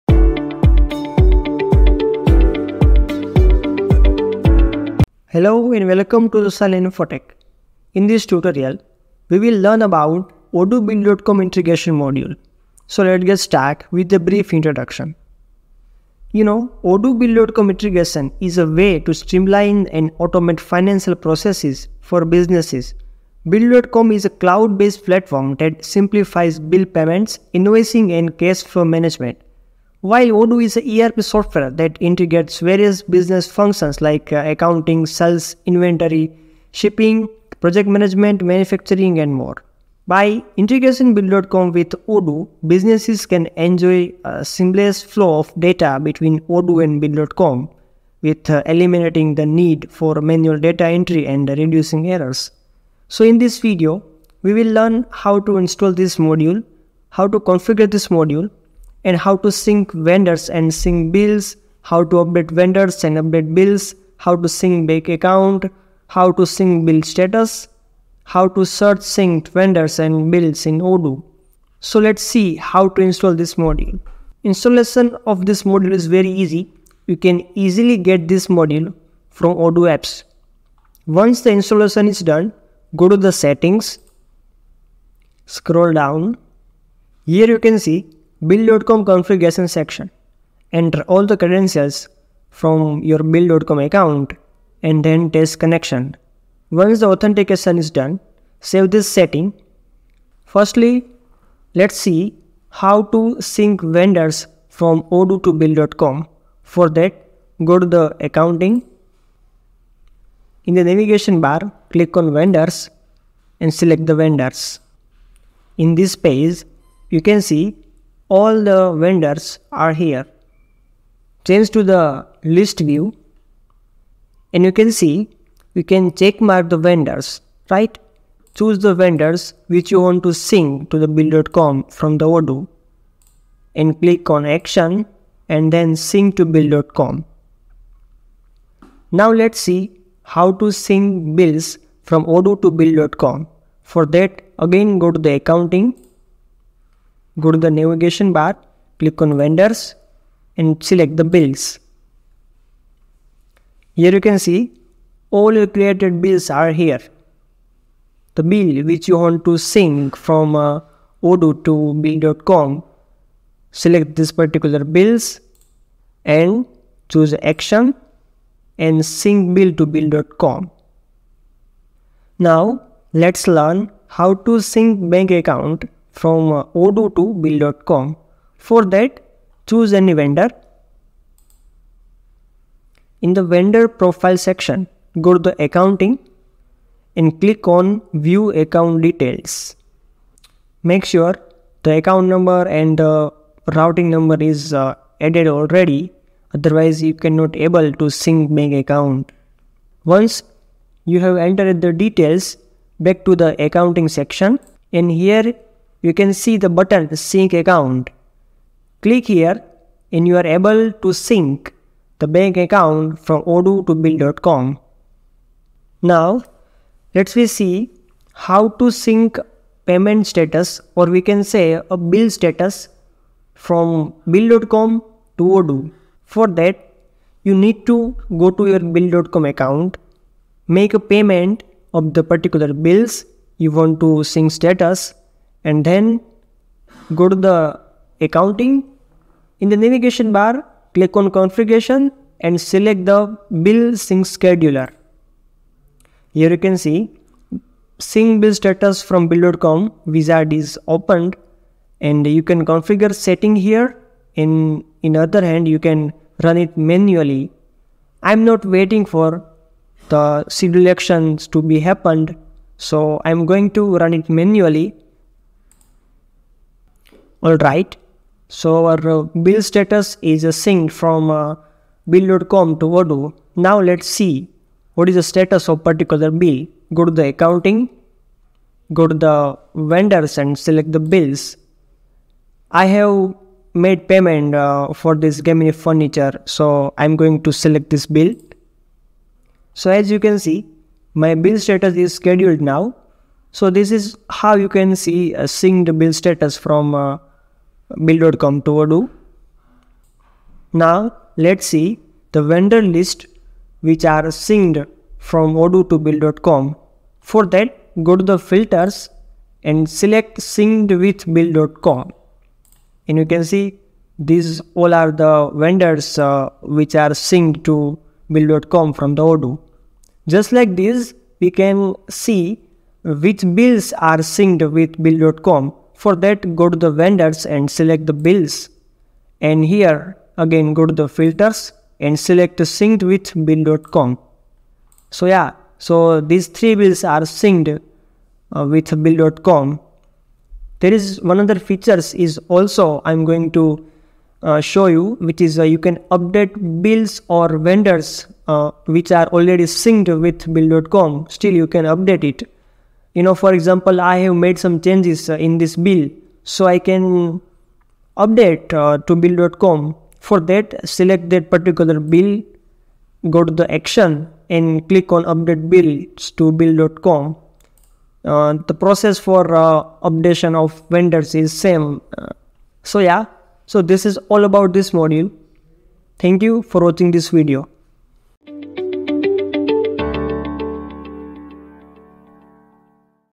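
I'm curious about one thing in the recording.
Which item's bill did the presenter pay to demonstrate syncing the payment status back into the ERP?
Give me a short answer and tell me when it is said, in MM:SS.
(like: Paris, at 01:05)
gaming furniture, at 04:45.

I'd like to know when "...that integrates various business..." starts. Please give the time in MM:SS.
00:31.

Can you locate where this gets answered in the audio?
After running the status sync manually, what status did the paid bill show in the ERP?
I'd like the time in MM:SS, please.
04:52.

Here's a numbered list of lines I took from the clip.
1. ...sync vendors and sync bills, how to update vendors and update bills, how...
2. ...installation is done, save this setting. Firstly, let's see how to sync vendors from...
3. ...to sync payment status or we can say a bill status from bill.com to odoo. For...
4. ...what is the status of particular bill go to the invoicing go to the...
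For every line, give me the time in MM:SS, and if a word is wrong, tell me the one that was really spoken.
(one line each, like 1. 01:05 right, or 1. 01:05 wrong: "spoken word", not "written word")
1. 00:59 right
2. 01:37 wrong: "authentication", not "installation"
3. 03:38 right
4. 04:34 wrong: "accounting", not "invoicing".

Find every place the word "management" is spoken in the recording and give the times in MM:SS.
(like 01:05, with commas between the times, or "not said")
00:28, 00:37.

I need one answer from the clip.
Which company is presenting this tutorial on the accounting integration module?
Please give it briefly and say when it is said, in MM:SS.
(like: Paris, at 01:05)
Silent Infotech, at 00:06.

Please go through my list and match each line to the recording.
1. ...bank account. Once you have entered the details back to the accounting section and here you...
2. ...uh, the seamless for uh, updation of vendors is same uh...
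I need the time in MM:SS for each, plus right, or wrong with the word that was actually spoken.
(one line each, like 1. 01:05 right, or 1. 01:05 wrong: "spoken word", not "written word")
1. 03:18 right
2. 06:08 wrong: "process", not "seamless".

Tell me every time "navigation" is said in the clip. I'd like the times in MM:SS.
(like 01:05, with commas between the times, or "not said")
01:50, 02:27, 03:59.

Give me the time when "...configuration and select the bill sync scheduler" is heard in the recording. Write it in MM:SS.
04:01.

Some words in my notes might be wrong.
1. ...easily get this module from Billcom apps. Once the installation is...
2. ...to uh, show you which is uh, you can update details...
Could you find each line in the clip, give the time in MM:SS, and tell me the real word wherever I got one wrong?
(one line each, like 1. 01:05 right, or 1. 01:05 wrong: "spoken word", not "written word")
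1. 01:17 wrong: "Odoo", not "Billcom"
2. 05:43 wrong: "bills", not "details".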